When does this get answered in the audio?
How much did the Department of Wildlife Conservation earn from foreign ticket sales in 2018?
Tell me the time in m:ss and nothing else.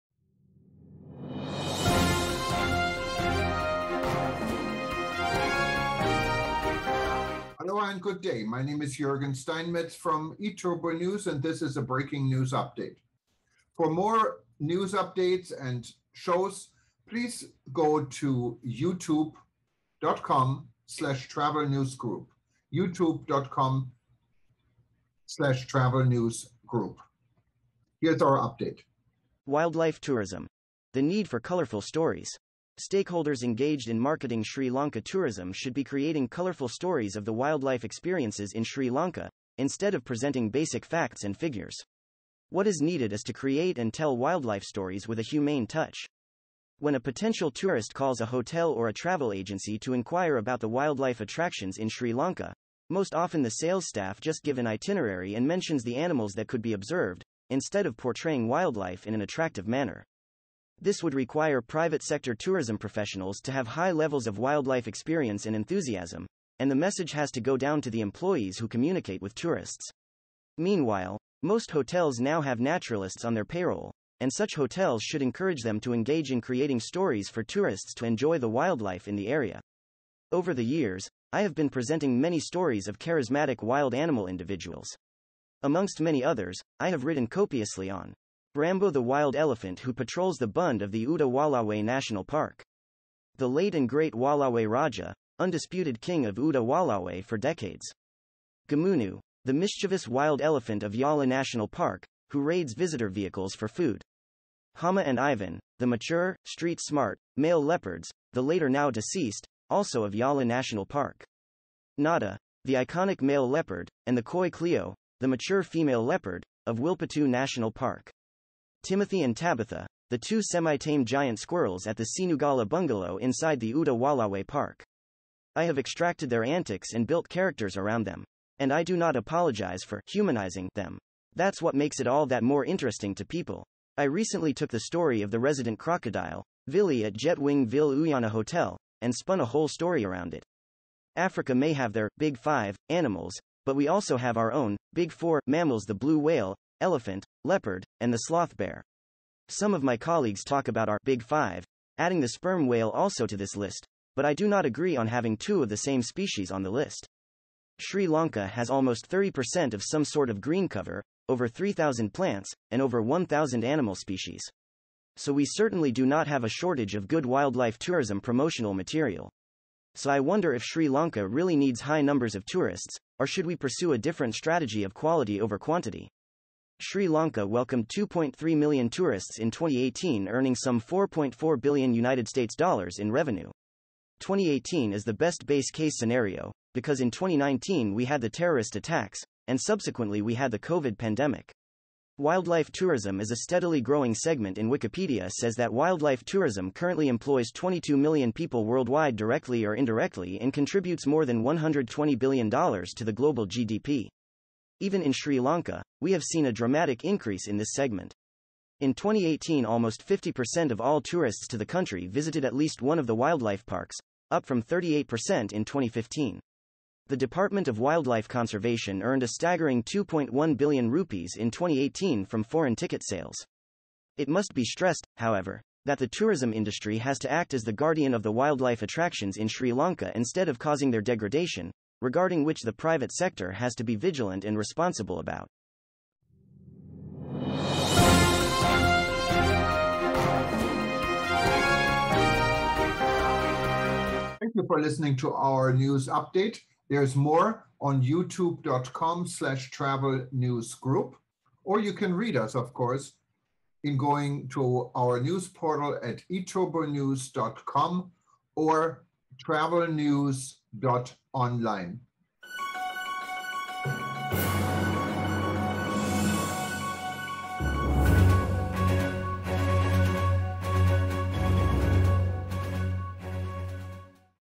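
3:39.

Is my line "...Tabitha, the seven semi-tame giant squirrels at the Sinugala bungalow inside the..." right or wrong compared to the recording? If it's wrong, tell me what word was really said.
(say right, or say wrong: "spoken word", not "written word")
wrong: "two", not "seven".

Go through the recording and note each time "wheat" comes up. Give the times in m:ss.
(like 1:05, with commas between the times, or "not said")
not said.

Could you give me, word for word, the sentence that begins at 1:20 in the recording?
Over the years, I have been presenting many stories of charismatic wild animal individuals.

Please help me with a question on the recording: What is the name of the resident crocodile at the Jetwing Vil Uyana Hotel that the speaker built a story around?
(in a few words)
Vili.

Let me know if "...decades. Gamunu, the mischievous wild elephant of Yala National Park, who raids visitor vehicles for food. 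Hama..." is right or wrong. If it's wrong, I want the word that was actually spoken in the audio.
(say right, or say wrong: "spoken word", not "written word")
right.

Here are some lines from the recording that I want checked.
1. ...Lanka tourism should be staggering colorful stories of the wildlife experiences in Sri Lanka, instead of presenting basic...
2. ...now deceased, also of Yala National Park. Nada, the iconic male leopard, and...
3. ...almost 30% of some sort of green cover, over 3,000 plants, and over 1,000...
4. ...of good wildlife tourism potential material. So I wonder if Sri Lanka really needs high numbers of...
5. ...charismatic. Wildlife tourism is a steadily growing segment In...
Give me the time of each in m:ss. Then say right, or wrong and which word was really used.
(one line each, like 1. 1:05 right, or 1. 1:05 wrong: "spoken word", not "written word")
1. 0:34 wrong: "creating", not "staggering"
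2. 1:48 right
3. 2:38 right
4. 2:46 wrong: "promotional", not "potential"
5. 3:10 wrong: "pandemic", not "charismatic".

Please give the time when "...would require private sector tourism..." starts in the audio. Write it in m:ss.
1:01.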